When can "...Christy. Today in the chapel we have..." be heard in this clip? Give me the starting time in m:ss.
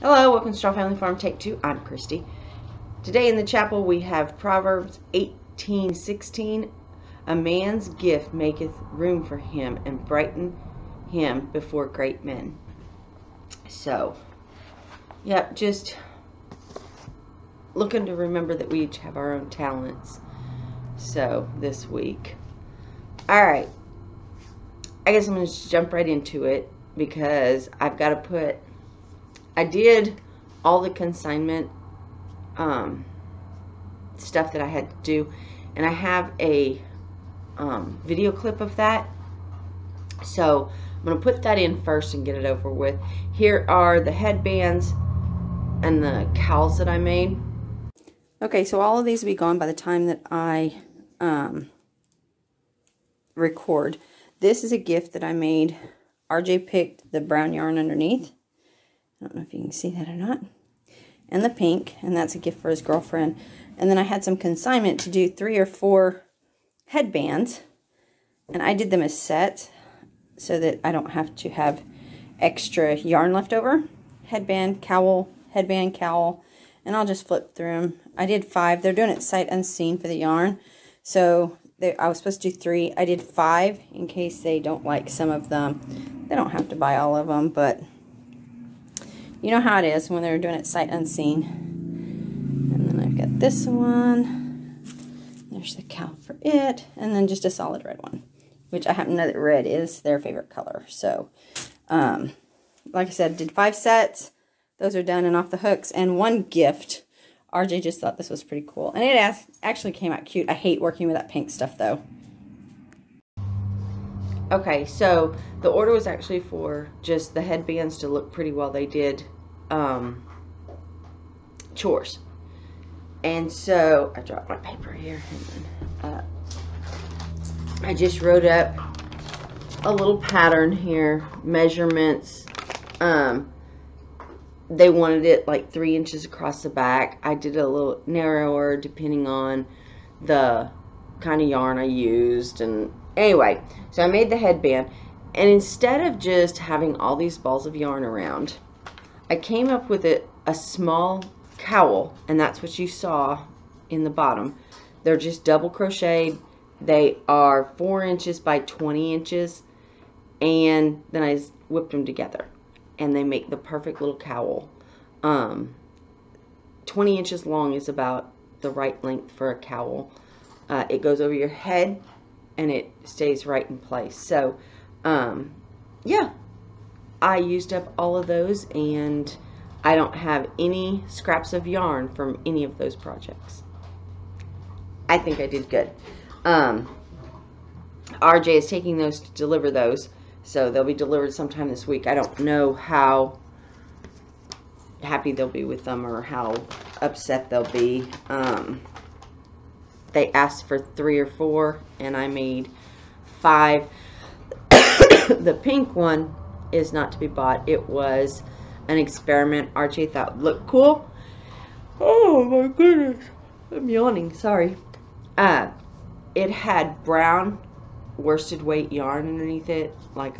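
0:01.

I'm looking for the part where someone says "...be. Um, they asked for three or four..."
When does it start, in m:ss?
3:17.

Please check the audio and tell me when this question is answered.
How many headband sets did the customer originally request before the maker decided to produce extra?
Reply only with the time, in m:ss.
1:21.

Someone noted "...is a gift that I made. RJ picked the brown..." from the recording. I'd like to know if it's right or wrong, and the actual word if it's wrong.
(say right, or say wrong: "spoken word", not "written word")
right.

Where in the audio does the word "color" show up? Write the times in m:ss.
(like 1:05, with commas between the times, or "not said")
1:40.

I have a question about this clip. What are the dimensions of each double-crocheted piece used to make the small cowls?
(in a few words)
4 inches by 20 inches.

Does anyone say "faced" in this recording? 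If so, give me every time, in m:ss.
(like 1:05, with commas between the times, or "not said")
not said.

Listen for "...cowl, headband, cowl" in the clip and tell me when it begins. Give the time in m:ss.
1:14.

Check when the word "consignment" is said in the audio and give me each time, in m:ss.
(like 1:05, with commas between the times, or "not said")
0:30, 1:04.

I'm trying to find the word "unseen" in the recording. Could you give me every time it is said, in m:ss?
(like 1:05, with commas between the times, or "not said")
1:19, 1:30.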